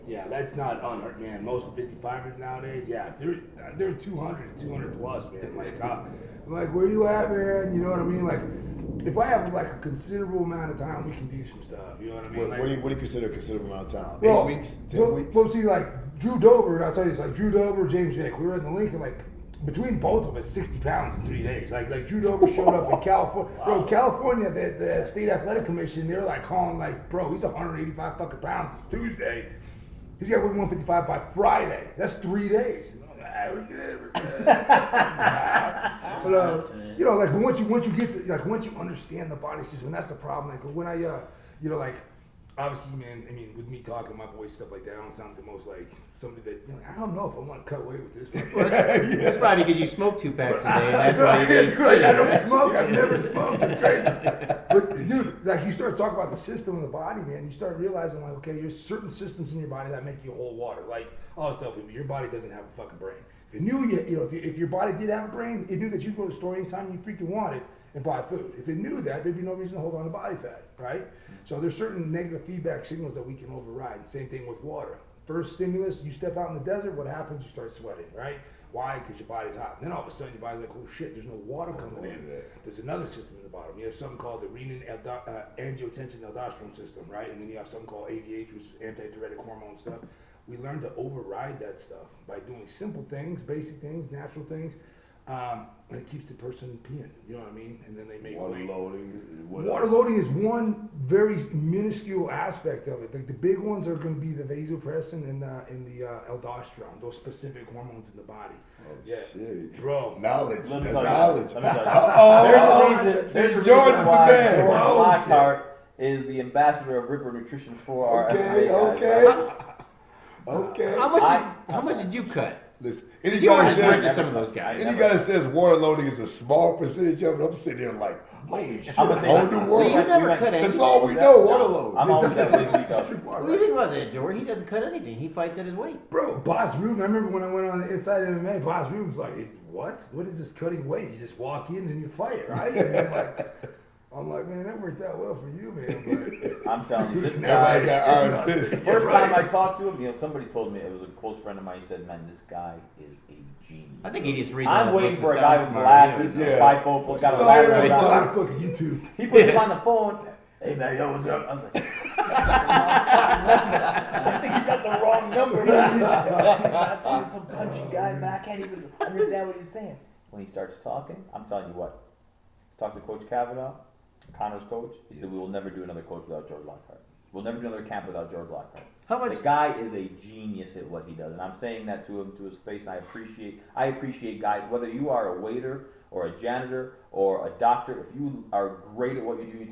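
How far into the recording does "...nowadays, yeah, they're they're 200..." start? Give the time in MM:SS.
00:02.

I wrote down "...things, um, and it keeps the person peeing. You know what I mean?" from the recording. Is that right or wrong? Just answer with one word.
right.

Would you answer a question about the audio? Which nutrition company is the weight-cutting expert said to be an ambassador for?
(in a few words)
Ripper Nutrition.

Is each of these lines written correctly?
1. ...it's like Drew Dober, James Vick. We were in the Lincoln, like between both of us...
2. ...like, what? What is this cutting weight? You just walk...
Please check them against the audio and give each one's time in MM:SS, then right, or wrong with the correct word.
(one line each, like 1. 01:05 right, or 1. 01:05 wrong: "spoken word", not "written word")
1. 00:17 right
2. 02:19 right.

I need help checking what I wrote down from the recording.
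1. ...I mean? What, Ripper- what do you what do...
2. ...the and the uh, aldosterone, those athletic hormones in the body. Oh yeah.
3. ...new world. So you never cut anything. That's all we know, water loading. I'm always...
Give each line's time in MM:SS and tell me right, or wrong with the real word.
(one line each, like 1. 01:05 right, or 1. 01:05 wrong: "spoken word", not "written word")
1. 00:12 wrong: "Like", not "Ripper"
2. 01:45 wrong: "specific", not "athletic"
3. 02:09 right.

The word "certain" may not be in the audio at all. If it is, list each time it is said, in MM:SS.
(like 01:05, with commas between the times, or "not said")
00:58, 01:11.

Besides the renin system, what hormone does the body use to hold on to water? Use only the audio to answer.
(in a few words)
antidiuretic hormone.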